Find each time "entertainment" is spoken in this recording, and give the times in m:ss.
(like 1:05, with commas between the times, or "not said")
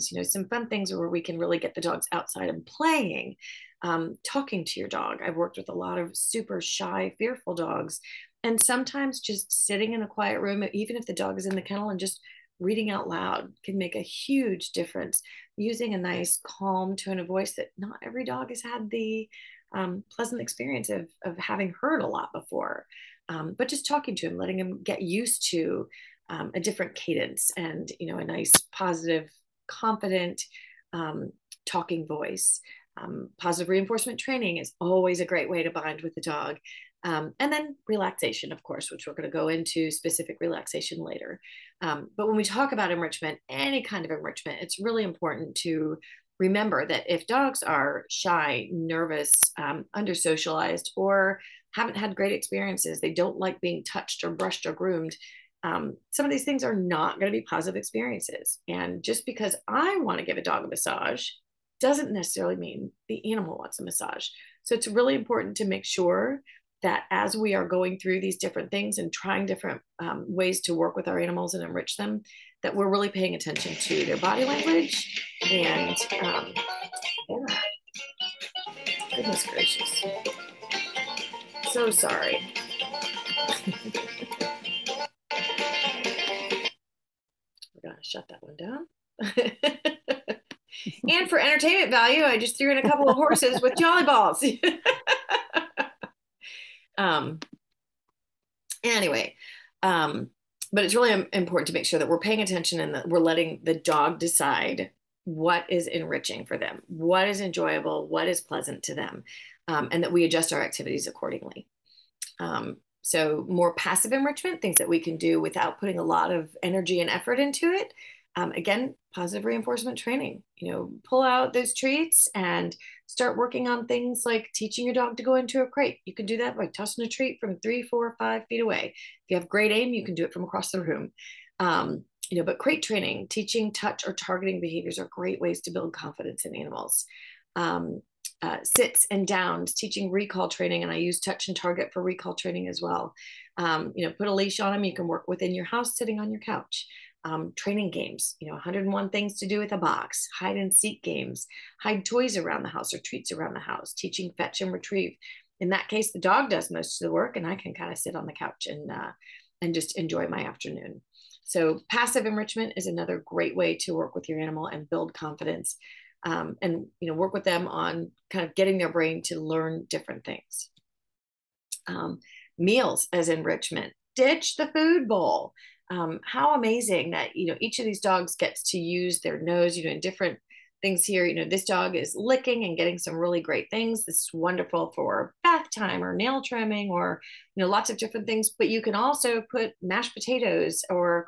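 1:31.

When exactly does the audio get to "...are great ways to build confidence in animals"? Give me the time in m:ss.
2:14.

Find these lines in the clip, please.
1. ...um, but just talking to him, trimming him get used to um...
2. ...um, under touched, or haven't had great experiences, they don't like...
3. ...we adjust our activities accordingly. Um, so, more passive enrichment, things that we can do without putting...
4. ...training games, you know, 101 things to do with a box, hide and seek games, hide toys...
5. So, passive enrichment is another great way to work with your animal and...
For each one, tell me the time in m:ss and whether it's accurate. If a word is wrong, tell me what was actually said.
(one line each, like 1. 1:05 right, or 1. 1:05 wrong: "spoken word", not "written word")
1. 0:23 wrong: "letting", not "trimming"
2. 0:49 wrong: "socialized", not "touched"
3. 1:50 right
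4. 2:27 right
5. 2:41 right.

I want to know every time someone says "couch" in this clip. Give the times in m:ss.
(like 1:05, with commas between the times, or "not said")
2:26, 2:38.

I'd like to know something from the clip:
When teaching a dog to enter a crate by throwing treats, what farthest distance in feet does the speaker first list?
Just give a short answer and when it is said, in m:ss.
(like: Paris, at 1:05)
5 feet, at 2:08.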